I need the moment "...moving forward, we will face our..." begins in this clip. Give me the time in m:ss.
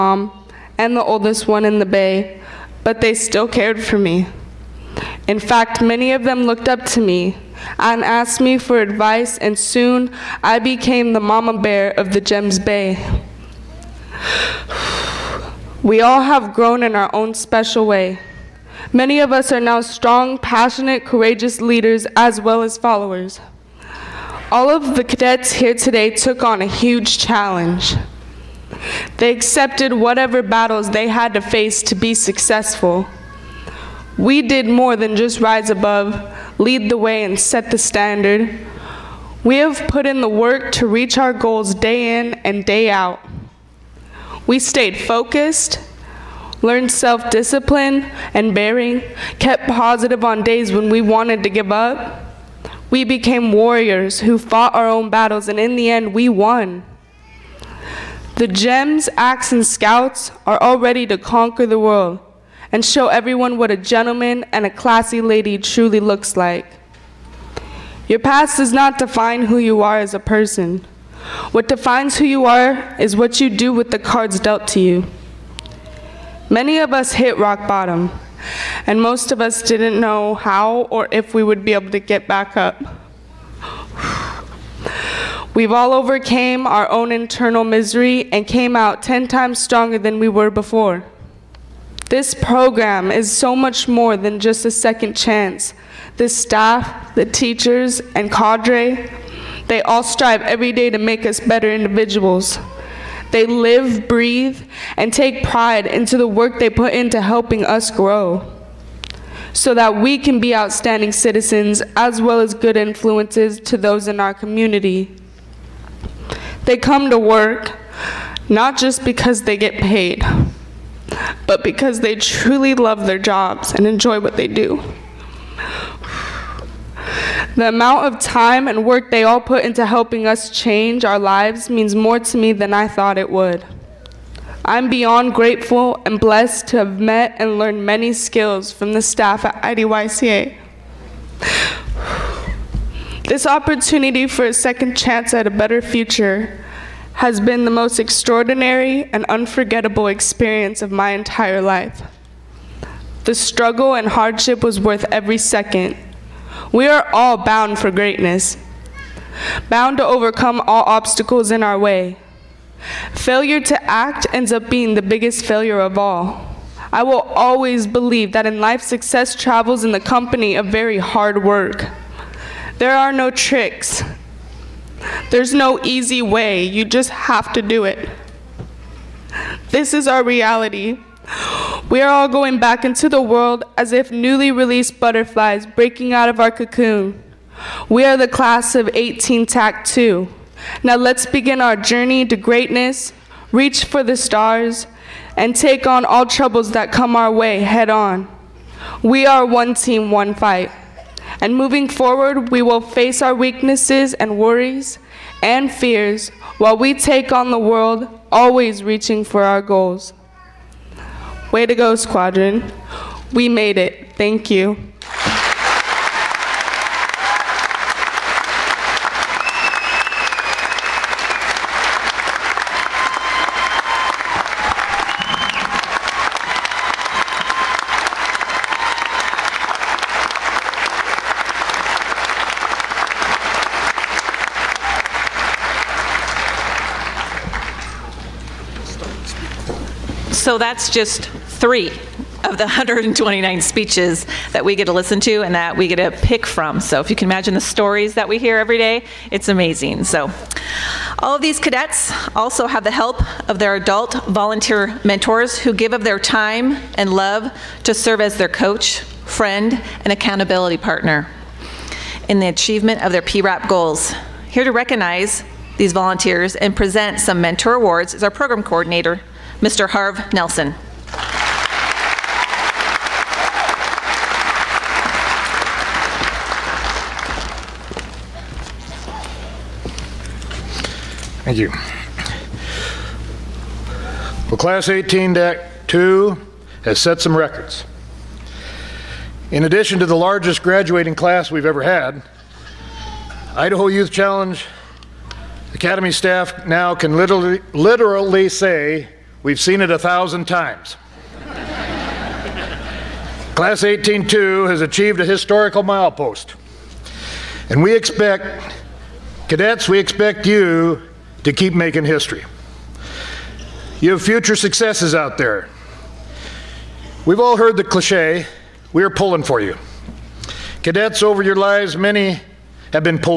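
3:21.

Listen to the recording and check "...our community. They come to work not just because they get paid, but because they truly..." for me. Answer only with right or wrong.
right.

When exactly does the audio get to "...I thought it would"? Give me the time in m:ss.
2:12.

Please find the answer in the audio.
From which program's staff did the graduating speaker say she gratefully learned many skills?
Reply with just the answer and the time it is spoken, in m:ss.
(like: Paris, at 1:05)
IDYCA, at 2:19.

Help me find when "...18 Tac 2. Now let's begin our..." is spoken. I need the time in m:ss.
3:08.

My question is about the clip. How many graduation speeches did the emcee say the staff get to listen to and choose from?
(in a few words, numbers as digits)
129.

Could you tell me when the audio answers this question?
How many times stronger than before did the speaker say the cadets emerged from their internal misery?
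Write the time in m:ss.
1:29.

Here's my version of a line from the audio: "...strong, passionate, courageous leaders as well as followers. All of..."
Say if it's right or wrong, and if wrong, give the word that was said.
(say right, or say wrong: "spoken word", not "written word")
right.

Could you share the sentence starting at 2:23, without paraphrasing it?
This opportunity for a second chance at a better future has been the most extraordinary and unforgettable experience of my entire life.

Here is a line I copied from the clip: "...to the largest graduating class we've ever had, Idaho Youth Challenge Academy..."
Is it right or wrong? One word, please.
right.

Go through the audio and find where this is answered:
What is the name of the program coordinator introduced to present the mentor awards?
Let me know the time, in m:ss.
4:29.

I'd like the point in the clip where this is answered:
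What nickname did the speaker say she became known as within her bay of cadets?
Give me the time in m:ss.
0:11.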